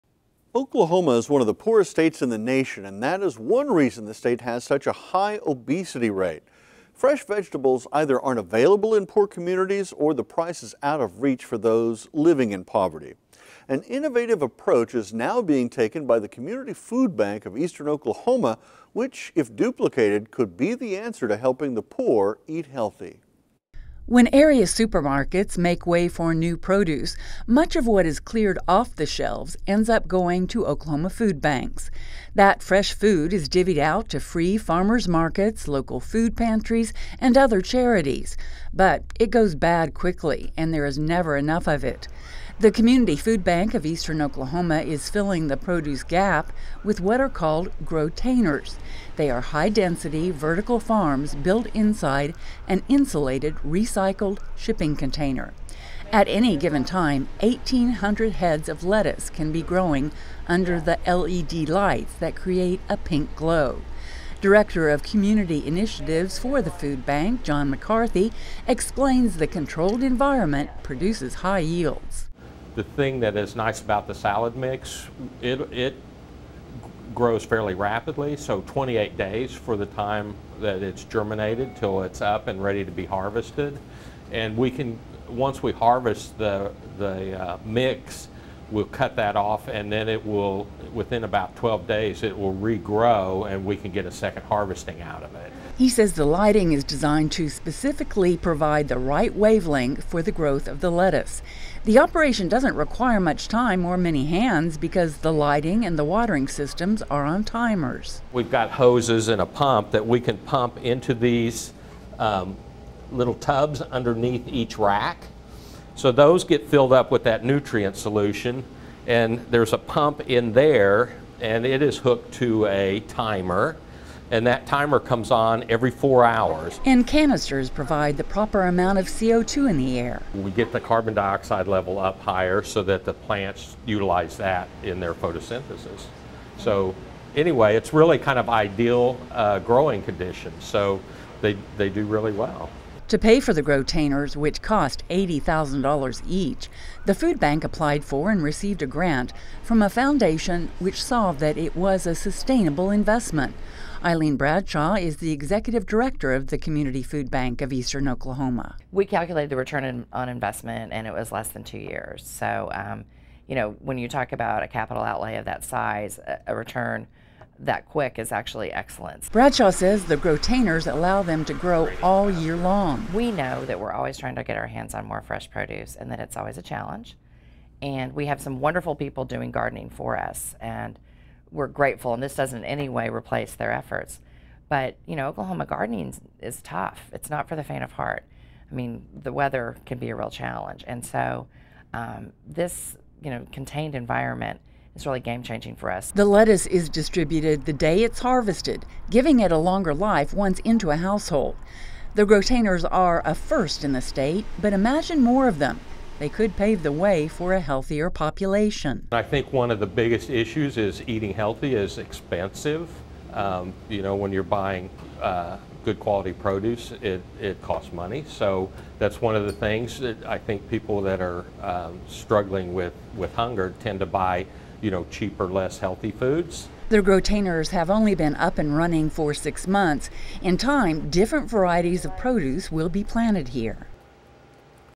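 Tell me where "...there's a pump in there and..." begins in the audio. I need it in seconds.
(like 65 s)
119 s.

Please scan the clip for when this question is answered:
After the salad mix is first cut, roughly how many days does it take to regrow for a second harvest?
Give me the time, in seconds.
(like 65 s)
91 s.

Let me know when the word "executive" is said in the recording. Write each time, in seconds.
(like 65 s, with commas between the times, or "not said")
155 s.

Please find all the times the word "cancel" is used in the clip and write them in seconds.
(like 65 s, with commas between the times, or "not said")
not said.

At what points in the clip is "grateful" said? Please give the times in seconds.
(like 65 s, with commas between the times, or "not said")
181 s.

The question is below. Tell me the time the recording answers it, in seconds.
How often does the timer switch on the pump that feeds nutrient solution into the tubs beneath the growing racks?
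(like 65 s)
125 s.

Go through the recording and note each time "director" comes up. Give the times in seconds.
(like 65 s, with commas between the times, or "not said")
64 s, 155 s.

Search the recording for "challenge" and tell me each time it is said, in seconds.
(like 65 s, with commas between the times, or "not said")
176 s, 190 s.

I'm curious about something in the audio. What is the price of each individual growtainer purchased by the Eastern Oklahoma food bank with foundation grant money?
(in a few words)
$80,000.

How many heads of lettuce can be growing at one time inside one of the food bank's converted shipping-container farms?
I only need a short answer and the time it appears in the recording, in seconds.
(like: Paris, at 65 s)
1,800, at 57 s.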